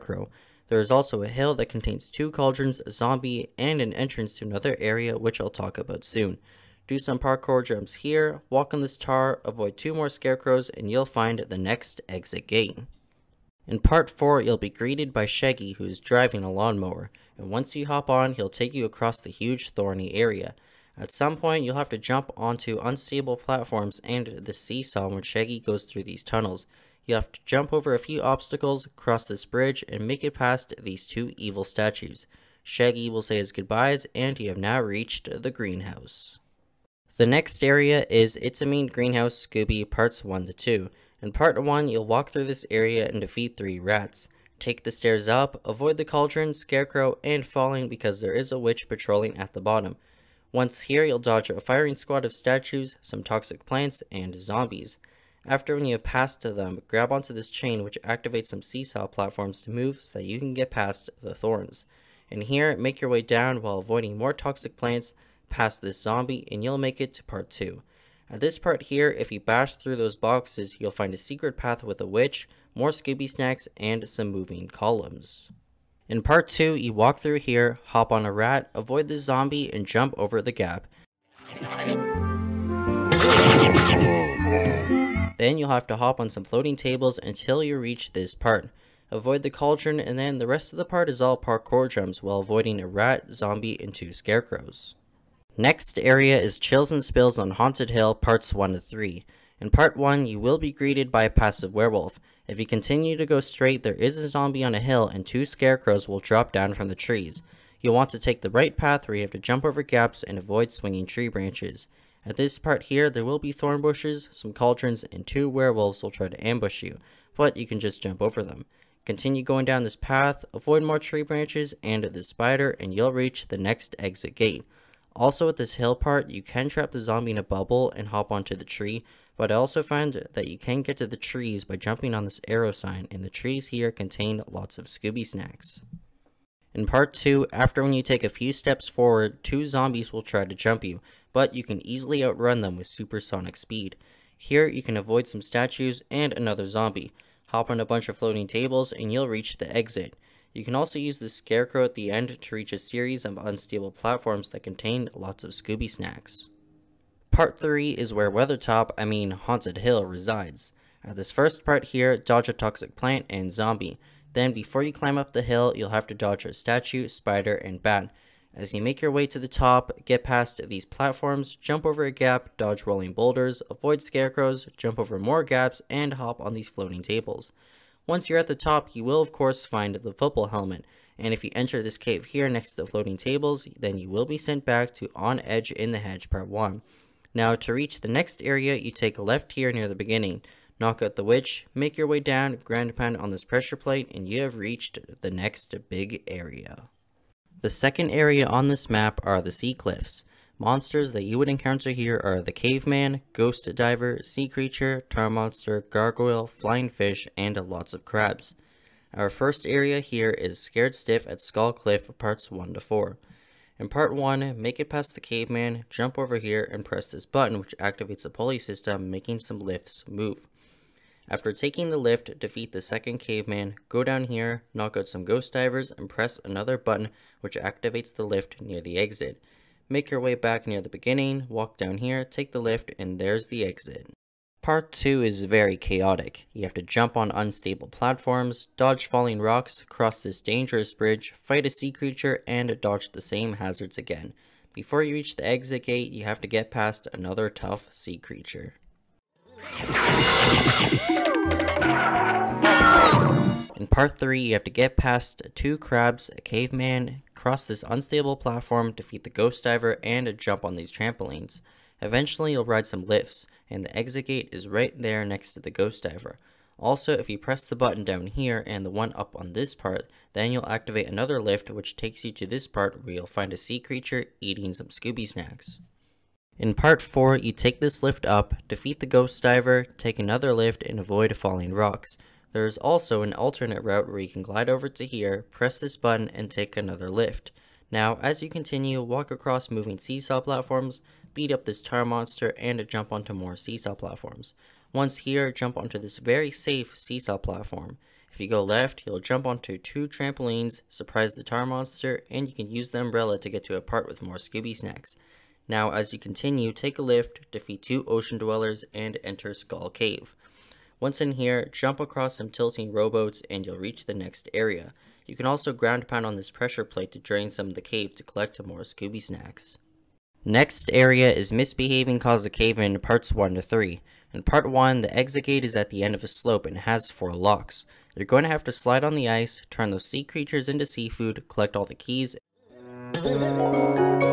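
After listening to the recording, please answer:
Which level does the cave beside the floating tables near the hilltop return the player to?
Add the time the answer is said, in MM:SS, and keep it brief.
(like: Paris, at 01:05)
On Edge in the Hedge, at 03:05.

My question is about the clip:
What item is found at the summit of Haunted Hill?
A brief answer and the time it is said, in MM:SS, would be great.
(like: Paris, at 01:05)
Football helmet, at 03:00.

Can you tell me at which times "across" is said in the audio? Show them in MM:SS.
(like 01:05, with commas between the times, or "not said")
00:18, 04:49, 05:11.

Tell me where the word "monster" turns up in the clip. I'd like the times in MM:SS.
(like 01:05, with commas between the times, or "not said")
03:20, 03:25, 04:52, 05:01.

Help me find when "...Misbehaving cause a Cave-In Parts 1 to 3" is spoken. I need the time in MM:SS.
05:21.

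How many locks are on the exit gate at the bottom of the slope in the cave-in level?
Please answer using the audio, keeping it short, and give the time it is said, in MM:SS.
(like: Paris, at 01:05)
4, at 05:27.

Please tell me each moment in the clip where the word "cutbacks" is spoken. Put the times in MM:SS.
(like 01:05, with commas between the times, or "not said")
not said.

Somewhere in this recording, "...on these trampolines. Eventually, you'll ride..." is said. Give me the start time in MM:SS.
04:20.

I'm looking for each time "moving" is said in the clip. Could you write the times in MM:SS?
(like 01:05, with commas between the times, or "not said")
01:14, 04:49.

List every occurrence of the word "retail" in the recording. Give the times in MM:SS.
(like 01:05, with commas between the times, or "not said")
not said.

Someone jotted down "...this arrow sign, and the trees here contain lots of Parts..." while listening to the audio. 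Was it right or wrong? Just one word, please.
wrong.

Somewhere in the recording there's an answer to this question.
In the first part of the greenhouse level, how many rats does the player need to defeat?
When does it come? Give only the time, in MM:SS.
00:43.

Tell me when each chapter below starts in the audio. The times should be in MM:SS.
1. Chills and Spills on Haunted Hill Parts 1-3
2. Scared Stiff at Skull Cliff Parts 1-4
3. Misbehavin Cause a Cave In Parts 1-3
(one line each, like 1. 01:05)
1. 01:34
2. 03:16
3. 05:19.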